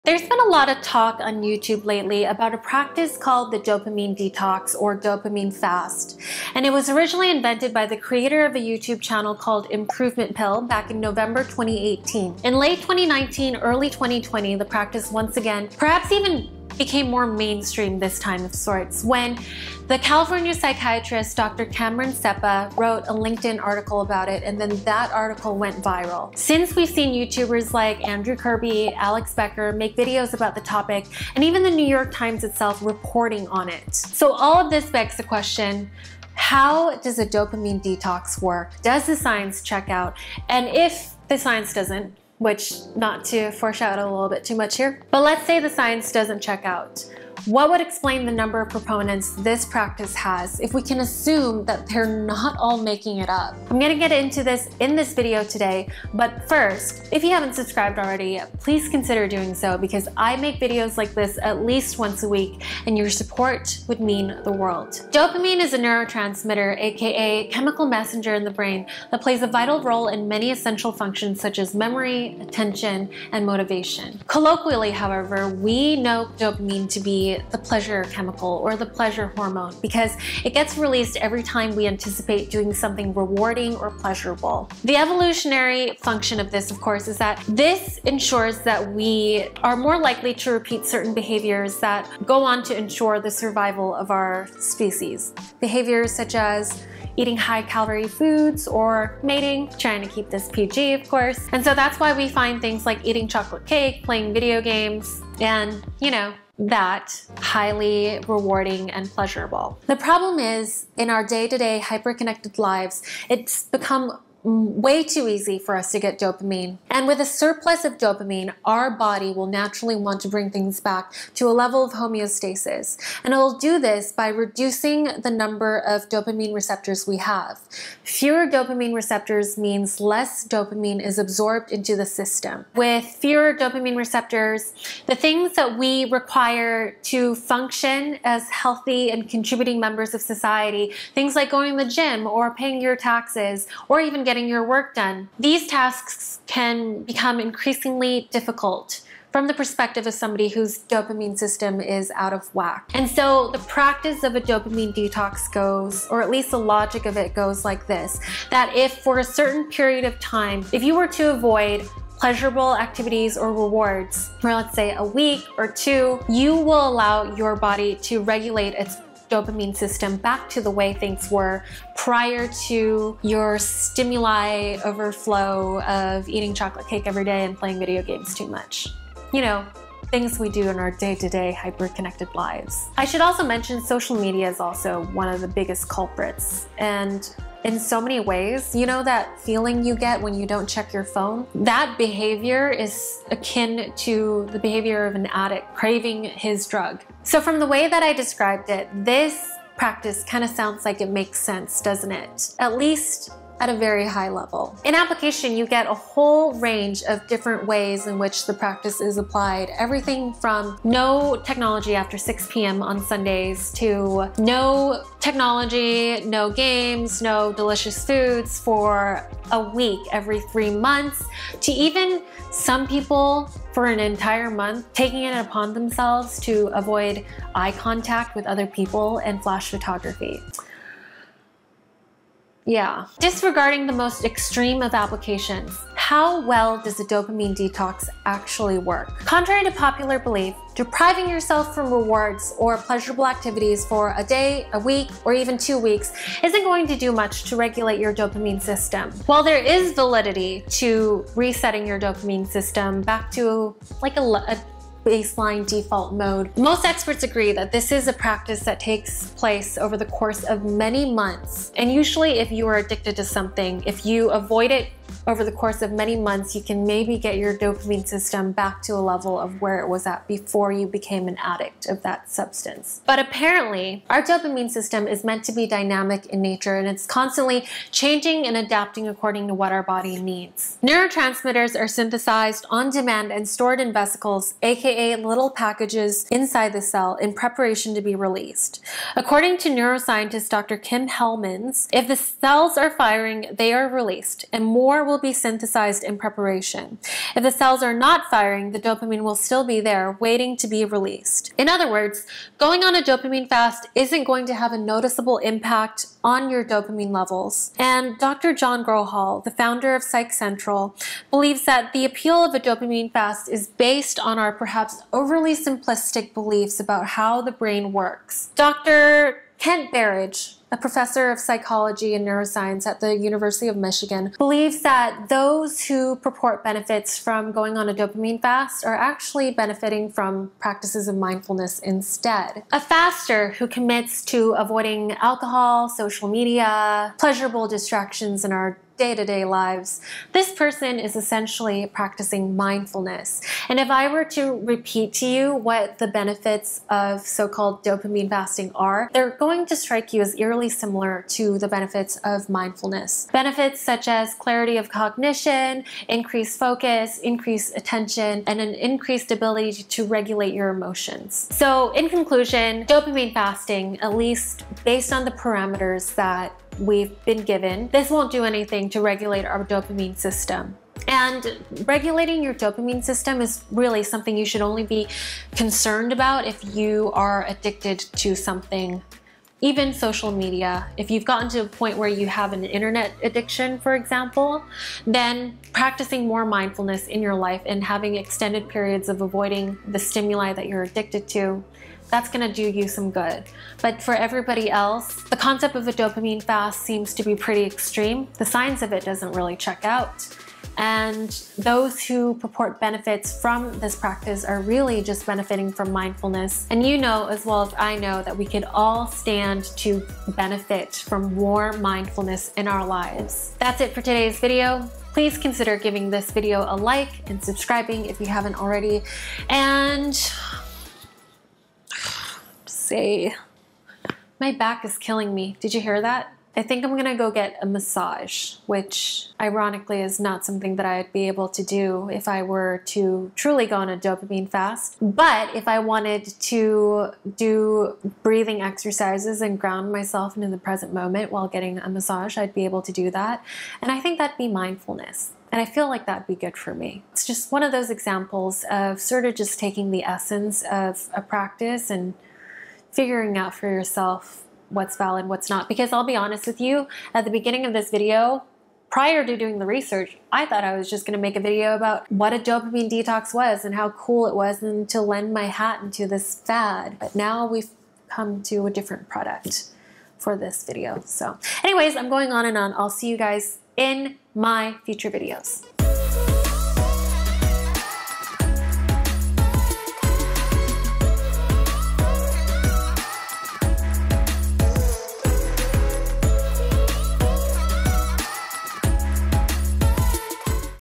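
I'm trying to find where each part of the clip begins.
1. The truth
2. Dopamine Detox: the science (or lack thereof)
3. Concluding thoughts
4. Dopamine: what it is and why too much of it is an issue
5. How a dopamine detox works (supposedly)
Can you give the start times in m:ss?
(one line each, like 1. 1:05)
1. 5:18
2. 3:52
3. 6:01
4. 1:05
5. 2:32.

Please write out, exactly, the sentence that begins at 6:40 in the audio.
And those who purport benefits from this practice are really just benefiting from mindfulness.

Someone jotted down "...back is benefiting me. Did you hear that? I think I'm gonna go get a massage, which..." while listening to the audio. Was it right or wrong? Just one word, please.
wrong.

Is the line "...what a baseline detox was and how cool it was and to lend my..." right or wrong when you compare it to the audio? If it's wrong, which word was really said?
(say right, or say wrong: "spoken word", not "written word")
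wrong: "dopamine", not "baseline".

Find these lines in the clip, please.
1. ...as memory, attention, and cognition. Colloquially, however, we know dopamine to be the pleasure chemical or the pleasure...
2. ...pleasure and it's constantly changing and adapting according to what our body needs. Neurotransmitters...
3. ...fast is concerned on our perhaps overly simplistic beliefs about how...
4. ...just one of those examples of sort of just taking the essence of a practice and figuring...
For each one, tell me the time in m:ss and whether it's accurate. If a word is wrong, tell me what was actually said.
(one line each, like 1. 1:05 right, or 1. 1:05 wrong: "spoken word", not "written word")
1. 1:11 wrong: "motivation", not "cognition"
2. 4:36 wrong: "nature", not "pleasure"
3. 5:13 wrong: "based", not "concerned"
4. 7:27 right.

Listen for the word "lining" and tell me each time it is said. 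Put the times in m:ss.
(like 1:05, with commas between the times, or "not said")
not said.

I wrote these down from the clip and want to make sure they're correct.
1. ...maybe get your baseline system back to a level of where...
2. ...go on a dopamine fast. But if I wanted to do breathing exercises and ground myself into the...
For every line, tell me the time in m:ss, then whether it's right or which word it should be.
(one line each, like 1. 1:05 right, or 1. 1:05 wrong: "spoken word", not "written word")
1. 4:26 wrong: "dopamine", not "baseline"
2. 7:13 right.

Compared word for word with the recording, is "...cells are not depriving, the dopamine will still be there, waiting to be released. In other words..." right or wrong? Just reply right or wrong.
wrong.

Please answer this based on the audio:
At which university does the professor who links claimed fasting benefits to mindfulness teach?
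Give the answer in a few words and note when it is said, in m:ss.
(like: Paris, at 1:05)
University of Michigan, at 5:23.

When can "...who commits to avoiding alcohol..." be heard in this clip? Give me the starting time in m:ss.
5:33.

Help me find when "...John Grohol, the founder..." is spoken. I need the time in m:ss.
5:08.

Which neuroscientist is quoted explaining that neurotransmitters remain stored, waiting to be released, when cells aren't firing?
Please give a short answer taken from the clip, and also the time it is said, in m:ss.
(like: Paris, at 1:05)
Kim Hellemans, at 4:50.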